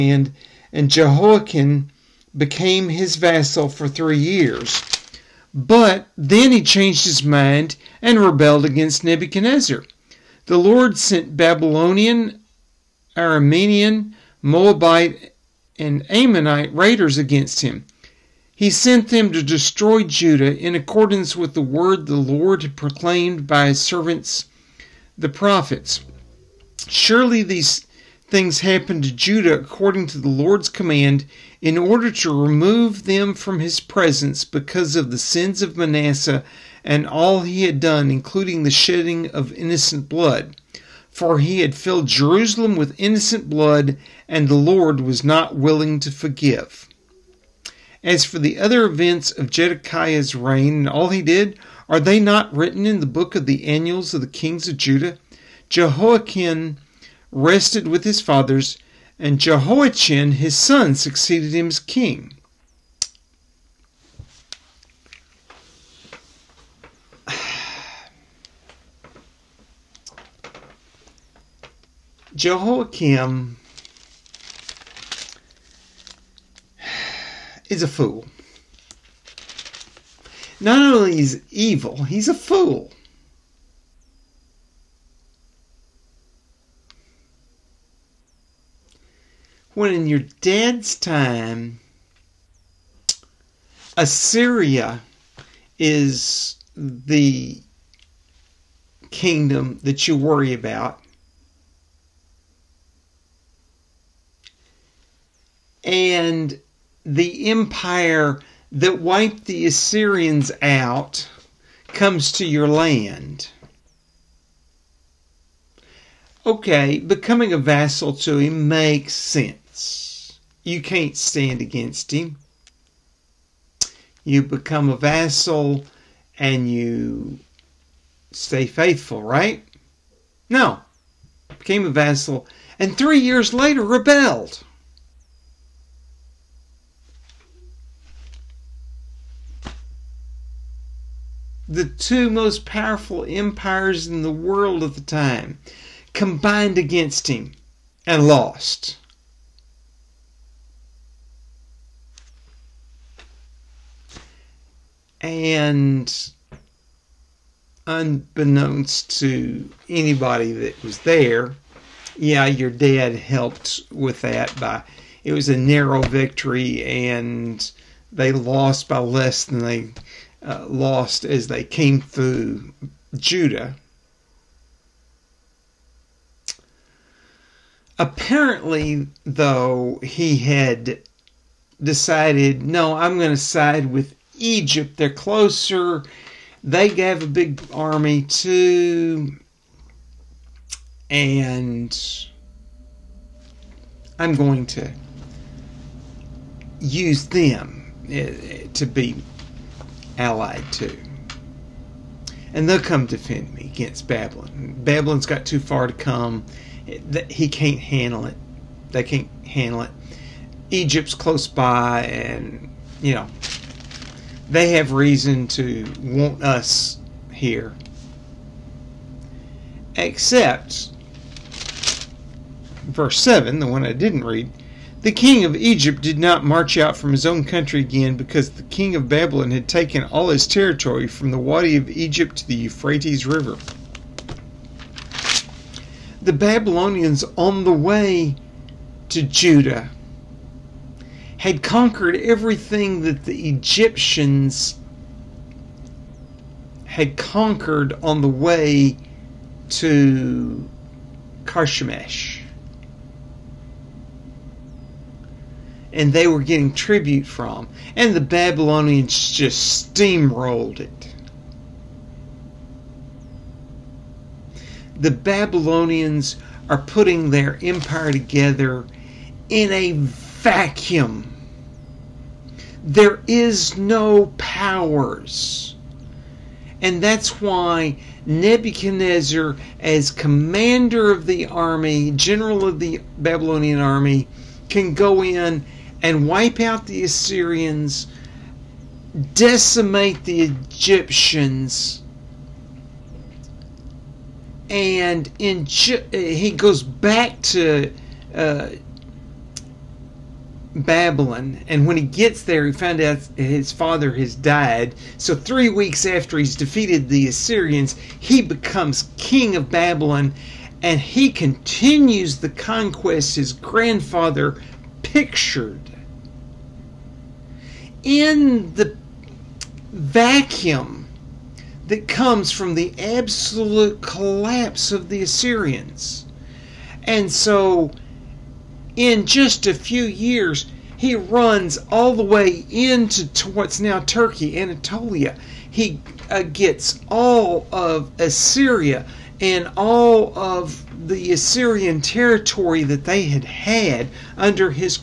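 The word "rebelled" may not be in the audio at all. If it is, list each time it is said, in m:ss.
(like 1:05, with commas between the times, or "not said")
0:08, 2:13.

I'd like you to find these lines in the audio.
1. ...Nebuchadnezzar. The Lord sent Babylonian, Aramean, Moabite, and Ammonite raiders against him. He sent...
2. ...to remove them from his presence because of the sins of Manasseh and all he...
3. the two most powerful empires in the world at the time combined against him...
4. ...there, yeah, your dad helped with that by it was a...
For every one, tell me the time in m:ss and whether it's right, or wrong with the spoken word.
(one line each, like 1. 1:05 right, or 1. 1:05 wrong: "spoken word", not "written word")
1. 0:09 right
2. 0:32 right
3. 2:21 right
4. 2:40 right.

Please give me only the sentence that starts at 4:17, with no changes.
And the Babylonians just steamrolled it.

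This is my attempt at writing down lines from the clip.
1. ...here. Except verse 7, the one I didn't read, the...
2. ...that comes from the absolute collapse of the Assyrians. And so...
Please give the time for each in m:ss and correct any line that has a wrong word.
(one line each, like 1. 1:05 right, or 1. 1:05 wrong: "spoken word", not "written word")
1. 3:37 right
2. 5:21 right.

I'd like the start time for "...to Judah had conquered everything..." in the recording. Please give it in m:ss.
3:59.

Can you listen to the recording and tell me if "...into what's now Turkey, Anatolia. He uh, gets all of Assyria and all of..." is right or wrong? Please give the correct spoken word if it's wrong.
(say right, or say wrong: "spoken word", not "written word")
right.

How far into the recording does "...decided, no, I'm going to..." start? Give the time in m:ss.
3:01.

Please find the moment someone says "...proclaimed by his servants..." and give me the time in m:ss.
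0:22.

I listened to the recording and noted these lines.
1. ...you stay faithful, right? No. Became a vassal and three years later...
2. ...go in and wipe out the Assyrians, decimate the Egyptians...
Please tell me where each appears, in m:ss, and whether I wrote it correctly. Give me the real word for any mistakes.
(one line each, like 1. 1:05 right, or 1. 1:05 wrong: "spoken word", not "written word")
1. 2:06 right
2. 4:44 right.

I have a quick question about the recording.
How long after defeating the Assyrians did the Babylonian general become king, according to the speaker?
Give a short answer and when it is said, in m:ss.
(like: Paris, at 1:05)
3 weeks, at 5:05.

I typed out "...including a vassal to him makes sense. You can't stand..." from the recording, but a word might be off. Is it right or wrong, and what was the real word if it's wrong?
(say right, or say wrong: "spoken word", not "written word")
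wrong: "becoming", not "including".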